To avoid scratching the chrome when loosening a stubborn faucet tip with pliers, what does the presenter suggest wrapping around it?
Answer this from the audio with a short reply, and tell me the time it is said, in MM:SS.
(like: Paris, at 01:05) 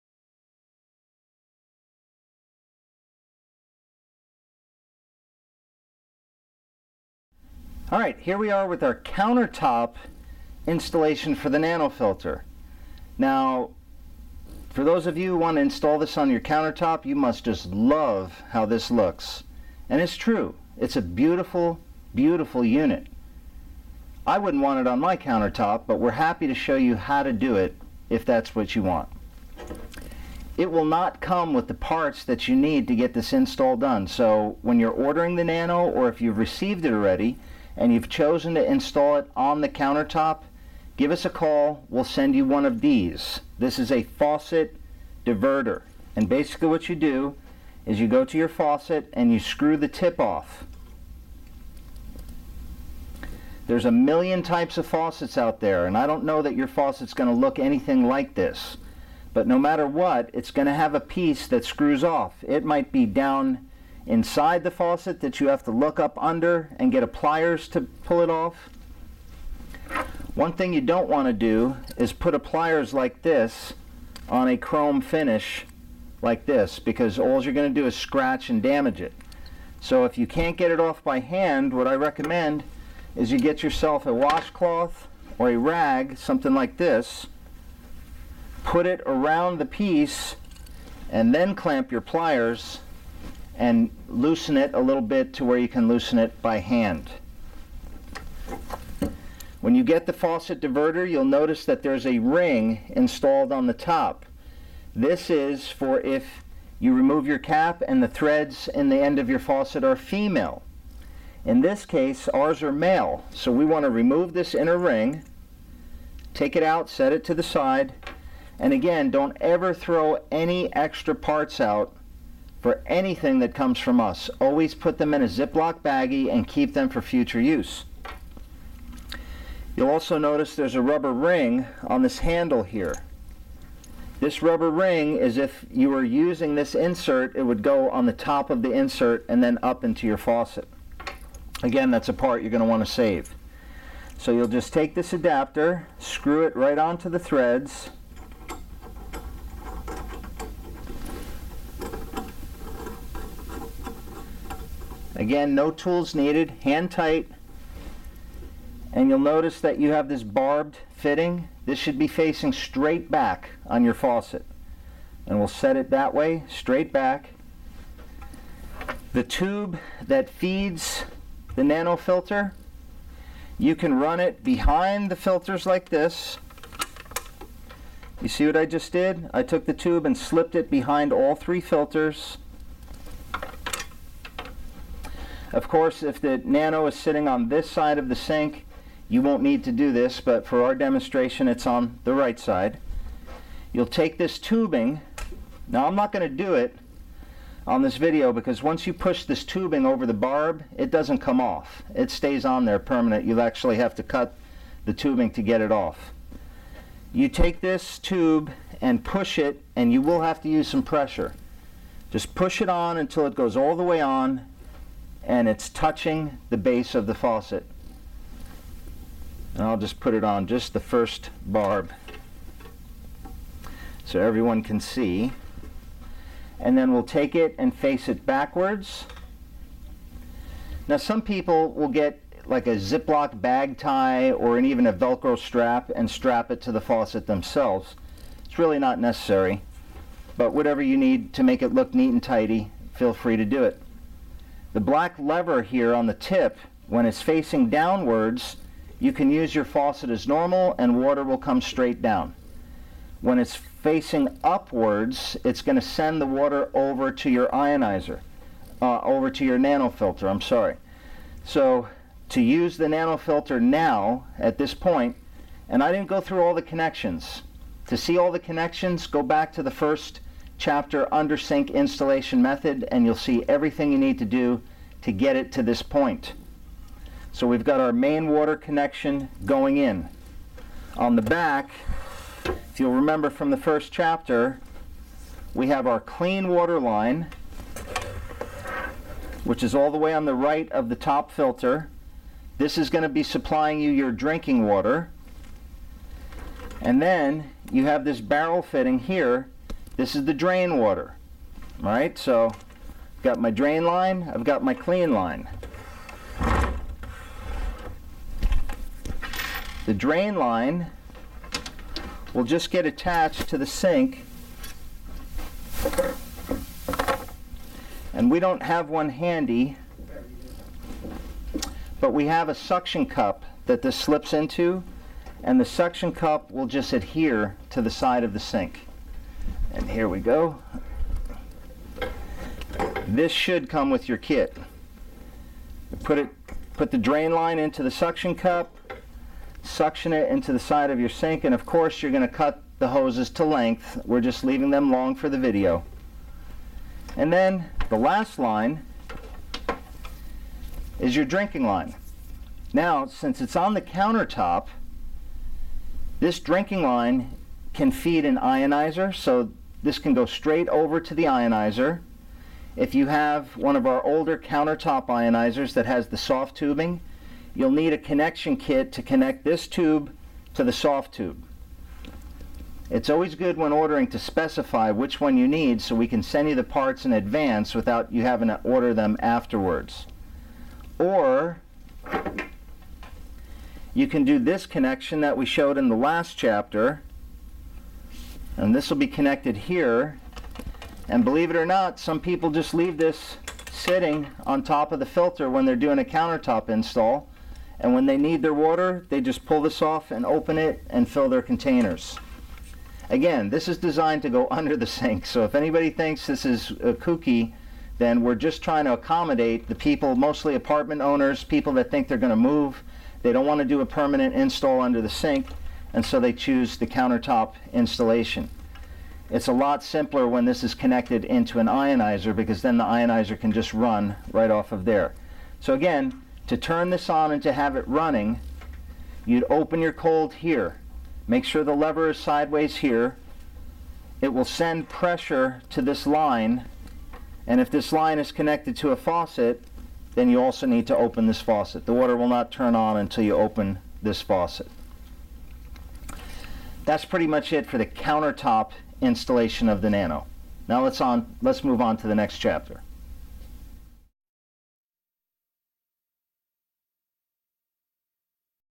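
a washcloth or a rag, at 01:24.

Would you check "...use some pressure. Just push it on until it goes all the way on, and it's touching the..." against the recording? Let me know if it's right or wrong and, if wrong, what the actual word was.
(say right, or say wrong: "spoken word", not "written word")
right.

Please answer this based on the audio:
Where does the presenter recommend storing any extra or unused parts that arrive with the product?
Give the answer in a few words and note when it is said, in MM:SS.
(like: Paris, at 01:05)
a Ziploc baggie, at 02:05.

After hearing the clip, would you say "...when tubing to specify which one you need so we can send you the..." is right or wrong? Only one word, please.
wrong.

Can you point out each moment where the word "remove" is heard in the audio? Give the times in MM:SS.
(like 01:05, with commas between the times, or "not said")
01:46, 01:53.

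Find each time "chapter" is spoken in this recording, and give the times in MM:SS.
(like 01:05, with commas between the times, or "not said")
04:30, 04:43, 06:26, 07:32.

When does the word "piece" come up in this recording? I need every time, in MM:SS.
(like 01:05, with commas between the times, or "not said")
01:00, 01:29.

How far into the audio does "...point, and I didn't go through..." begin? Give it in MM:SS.
04:24.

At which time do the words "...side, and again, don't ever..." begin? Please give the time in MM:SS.
01:57.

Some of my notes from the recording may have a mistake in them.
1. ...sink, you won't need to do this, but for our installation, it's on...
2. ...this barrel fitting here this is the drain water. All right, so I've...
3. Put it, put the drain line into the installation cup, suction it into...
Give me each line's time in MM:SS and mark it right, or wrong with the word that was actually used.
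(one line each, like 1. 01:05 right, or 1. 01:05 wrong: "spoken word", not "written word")
1. 03:08 wrong: "demonstration", not "installation"
2. 04:58 right
3. 05:36 wrong: "suction", not "installation".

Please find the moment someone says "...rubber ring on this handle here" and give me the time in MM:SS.
02:10.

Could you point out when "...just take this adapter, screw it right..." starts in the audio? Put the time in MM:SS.
02:24.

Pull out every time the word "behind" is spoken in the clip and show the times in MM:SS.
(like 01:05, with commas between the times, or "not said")
02:54, 03:00.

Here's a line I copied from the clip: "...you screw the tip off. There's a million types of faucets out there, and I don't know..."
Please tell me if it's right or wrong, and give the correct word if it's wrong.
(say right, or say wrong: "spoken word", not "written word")
right.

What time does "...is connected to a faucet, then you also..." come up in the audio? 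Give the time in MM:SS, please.
07:18.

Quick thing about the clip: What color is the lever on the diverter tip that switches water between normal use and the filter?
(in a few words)
black.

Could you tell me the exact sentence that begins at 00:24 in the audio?
I wouldn't want it on my countertop, but we're happy to show you how to do it if that's what you want.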